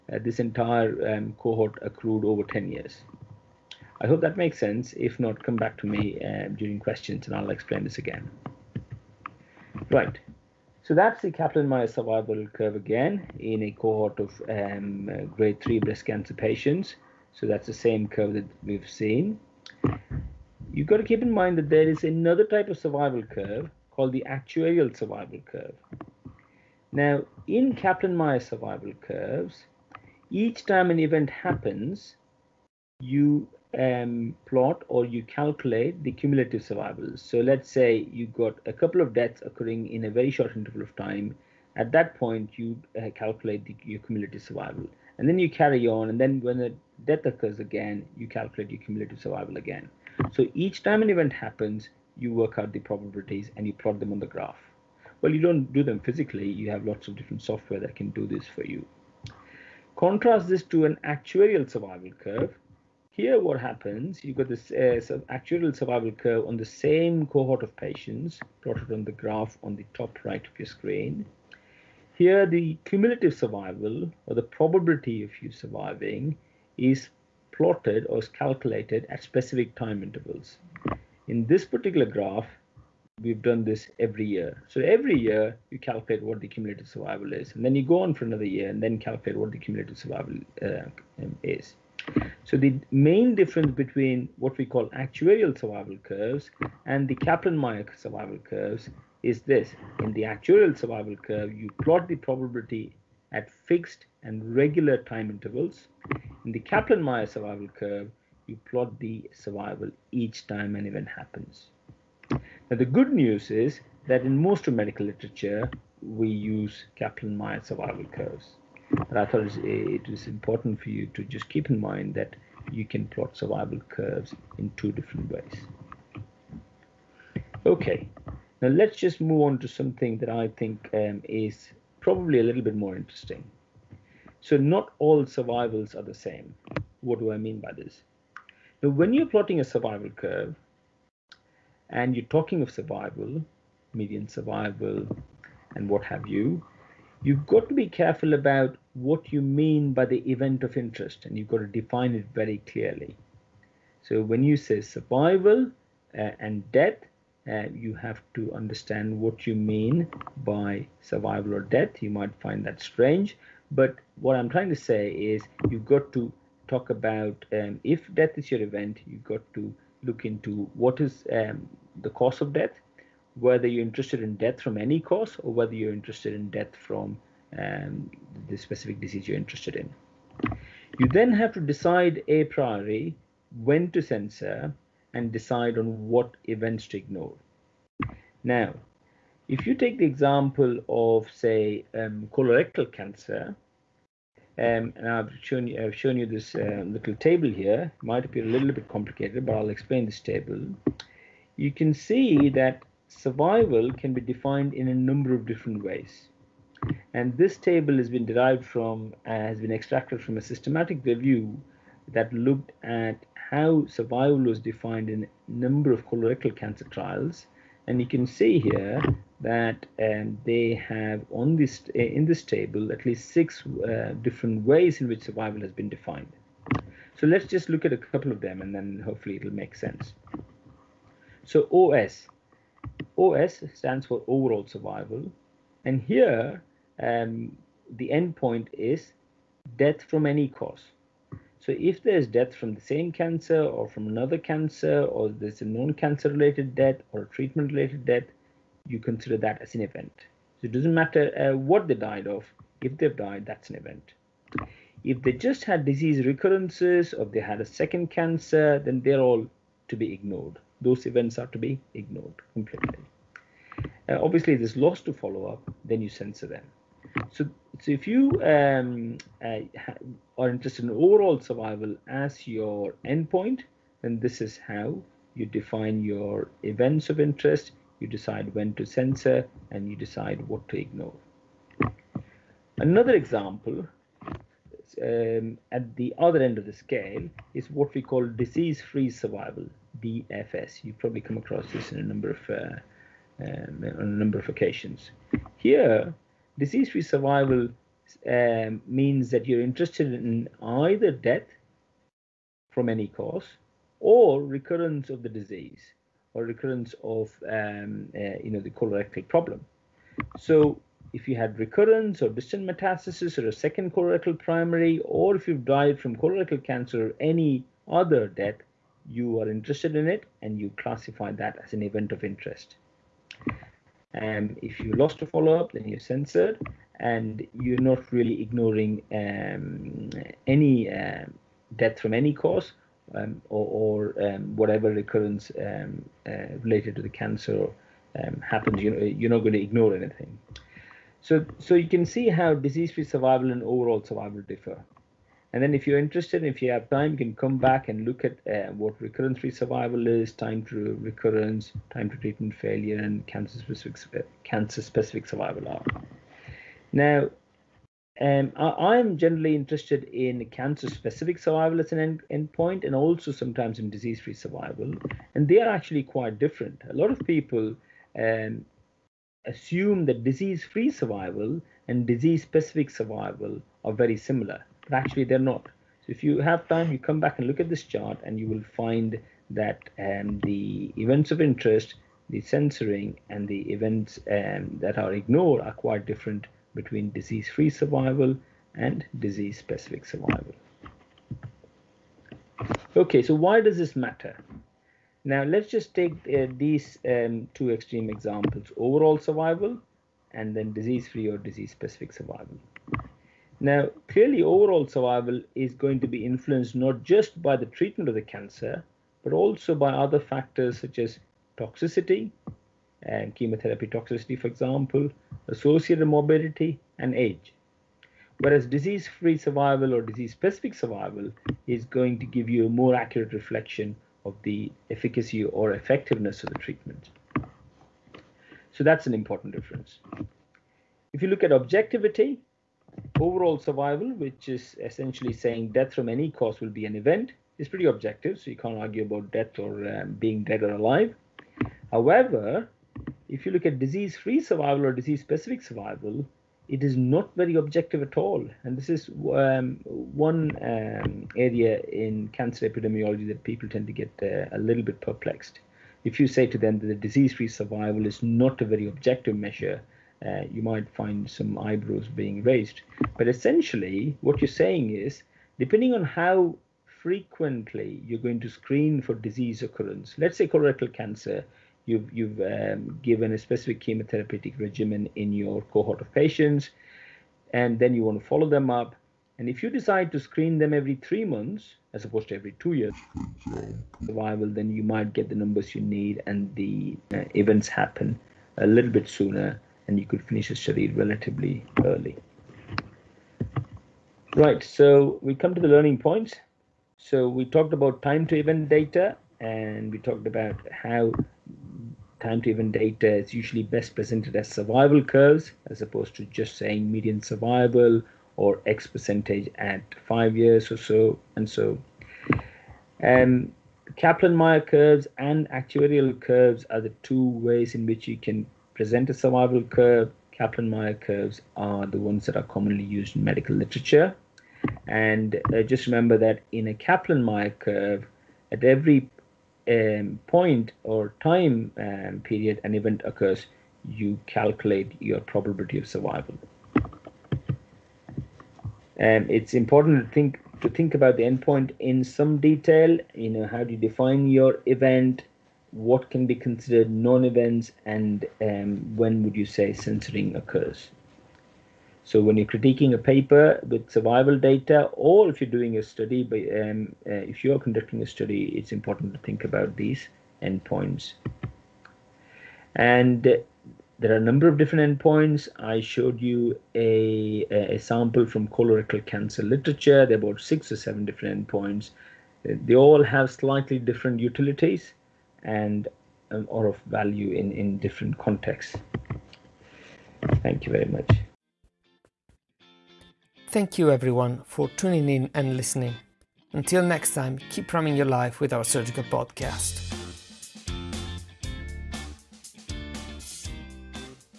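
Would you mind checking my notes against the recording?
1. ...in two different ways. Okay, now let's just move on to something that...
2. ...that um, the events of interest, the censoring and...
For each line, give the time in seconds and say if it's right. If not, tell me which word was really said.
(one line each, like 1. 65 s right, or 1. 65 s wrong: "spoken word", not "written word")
1. 124 s right
2. 379 s right.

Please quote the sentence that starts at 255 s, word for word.
If they just had disease recurrences or they had a second cancer, then they're all to be ignored.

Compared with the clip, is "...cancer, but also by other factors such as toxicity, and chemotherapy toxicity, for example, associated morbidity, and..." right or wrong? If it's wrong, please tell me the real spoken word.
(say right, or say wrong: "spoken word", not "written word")
right.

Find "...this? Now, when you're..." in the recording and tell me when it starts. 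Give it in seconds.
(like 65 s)
137 s.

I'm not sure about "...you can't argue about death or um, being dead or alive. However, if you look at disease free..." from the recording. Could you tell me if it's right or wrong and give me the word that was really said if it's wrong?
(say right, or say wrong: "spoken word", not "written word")
right.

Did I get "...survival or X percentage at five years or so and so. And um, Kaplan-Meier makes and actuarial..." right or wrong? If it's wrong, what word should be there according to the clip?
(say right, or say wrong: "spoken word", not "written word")
wrong: "curves", not "makes".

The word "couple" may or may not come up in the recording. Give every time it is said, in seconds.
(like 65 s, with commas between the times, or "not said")
38 s, 227 s.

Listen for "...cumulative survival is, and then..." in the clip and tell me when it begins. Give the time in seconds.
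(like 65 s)
86 s.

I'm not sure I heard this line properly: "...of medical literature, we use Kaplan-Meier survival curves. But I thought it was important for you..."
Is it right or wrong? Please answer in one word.
right.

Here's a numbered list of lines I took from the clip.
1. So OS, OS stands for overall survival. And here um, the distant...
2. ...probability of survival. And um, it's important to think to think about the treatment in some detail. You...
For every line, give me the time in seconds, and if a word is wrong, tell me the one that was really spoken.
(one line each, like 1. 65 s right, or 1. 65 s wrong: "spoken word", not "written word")
1. 231 s wrong: "endpoint", not "distant"
2. 535 s wrong: "endpoint", not "treatment".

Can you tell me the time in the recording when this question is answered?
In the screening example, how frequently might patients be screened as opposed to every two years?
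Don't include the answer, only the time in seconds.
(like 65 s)
480 s.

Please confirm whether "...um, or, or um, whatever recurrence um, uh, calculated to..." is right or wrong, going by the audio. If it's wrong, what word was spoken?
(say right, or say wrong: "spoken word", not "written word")
wrong: "related", not "calculated".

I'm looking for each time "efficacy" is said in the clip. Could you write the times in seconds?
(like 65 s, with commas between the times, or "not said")
424 s.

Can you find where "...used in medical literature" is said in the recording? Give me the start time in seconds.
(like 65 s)
522 s.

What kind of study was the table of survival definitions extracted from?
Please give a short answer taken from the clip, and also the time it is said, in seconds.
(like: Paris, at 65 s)
A systematic review, at 210 s.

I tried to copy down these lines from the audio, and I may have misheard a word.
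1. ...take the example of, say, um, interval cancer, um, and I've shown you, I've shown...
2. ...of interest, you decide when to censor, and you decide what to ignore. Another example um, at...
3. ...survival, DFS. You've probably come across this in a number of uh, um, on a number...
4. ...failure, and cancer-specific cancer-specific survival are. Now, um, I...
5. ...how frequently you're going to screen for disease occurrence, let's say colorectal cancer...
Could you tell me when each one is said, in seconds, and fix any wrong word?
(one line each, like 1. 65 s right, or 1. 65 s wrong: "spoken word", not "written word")
1. 189 s wrong: "colorectal", not "interval"
2. 277 s right
3. 289 s right
4. 352 s right
5. 466 s right.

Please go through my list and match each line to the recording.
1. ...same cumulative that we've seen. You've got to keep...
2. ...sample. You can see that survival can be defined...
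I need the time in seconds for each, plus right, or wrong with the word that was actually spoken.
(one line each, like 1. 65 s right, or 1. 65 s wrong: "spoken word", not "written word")
1. 17 s wrong: "curve", not "cumulative"
2. 200 s wrong: "table", not "sample".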